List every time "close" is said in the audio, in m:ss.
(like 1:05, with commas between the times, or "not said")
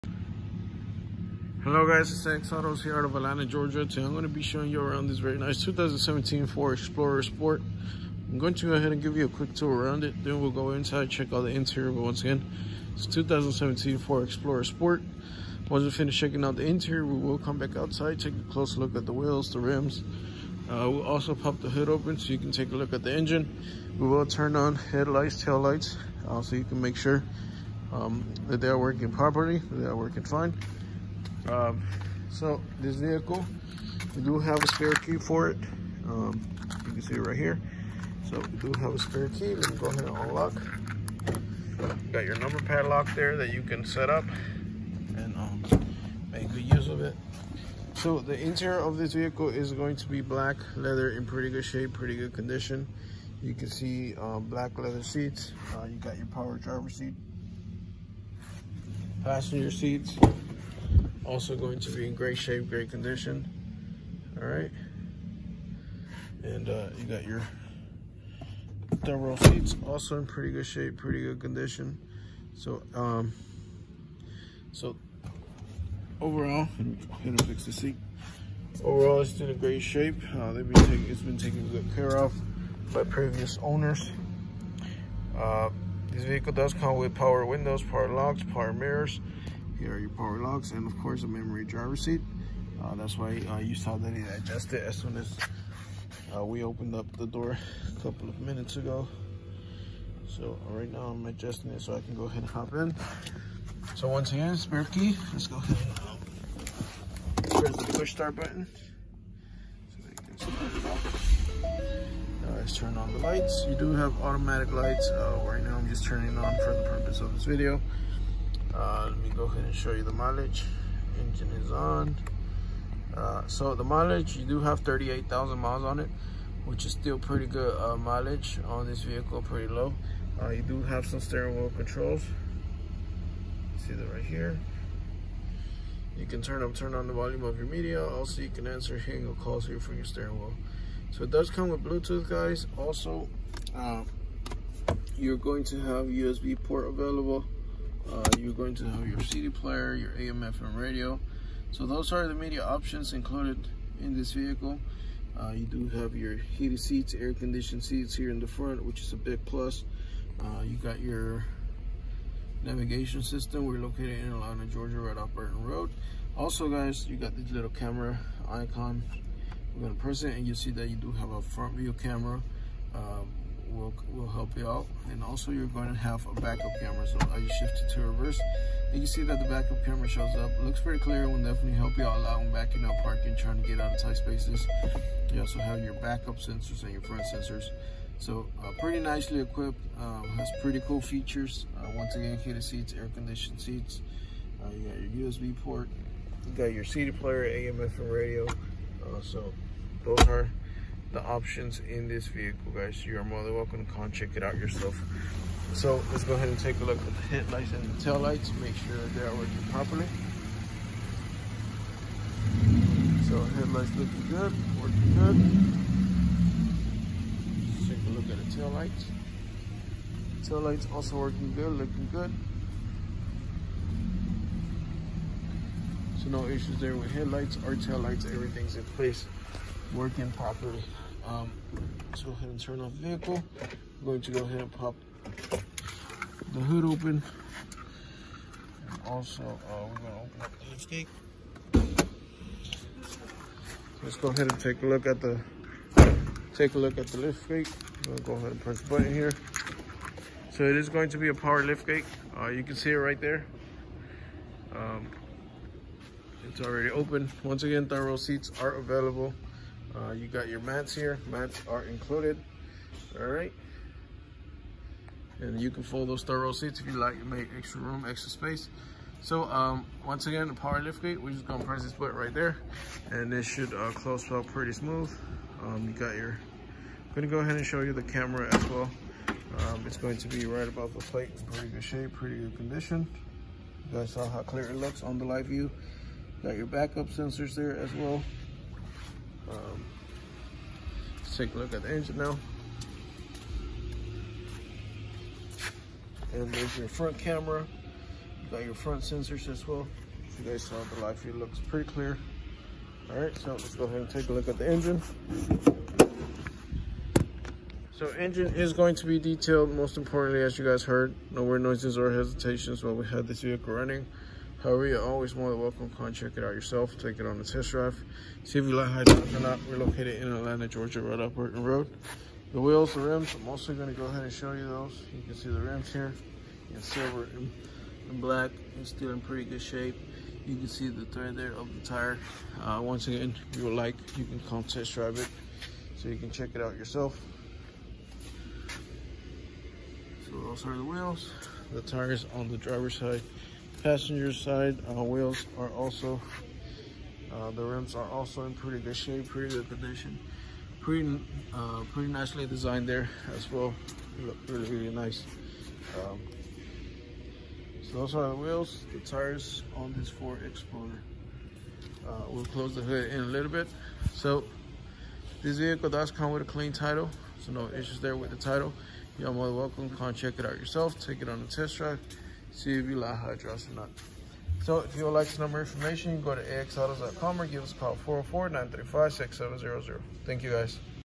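0:18, 4:33, 6:02.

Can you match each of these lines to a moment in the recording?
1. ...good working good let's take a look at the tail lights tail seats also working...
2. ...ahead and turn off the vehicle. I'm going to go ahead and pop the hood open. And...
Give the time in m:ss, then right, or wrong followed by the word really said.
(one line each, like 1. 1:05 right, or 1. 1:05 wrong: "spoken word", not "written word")
1. 3:34 wrong: "lights", not "seats"
2. 3:52 right.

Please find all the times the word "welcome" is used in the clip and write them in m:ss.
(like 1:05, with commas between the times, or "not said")
3:23, 5:15, 6:09.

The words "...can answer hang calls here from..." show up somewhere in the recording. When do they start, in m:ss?
2:18.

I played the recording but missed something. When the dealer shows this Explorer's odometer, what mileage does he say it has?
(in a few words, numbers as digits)
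38,000 miles.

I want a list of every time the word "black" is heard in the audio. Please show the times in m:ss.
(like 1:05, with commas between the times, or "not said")
0:50, 0:54, 5:28.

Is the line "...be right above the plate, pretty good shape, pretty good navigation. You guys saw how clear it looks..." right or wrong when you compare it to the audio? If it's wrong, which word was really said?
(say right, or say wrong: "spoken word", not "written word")
wrong: "condition", not "navigation".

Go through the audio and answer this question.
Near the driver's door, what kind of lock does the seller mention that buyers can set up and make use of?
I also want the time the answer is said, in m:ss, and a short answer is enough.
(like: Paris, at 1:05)
Number padlock, at 0:42.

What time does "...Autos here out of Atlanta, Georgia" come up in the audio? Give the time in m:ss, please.
0:02.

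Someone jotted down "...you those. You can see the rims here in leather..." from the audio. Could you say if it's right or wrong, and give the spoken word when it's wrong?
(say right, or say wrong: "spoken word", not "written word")
wrong: "silver", not "leather".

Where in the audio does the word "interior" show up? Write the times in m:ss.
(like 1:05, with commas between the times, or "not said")
0:11, 0:16, 0:48.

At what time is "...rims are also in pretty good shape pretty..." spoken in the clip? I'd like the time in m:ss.
5:47.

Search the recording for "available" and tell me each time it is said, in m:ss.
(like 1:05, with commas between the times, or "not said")
2:26, 4:18.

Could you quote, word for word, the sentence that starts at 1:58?
Uh, let me go ahead and show you the mileage.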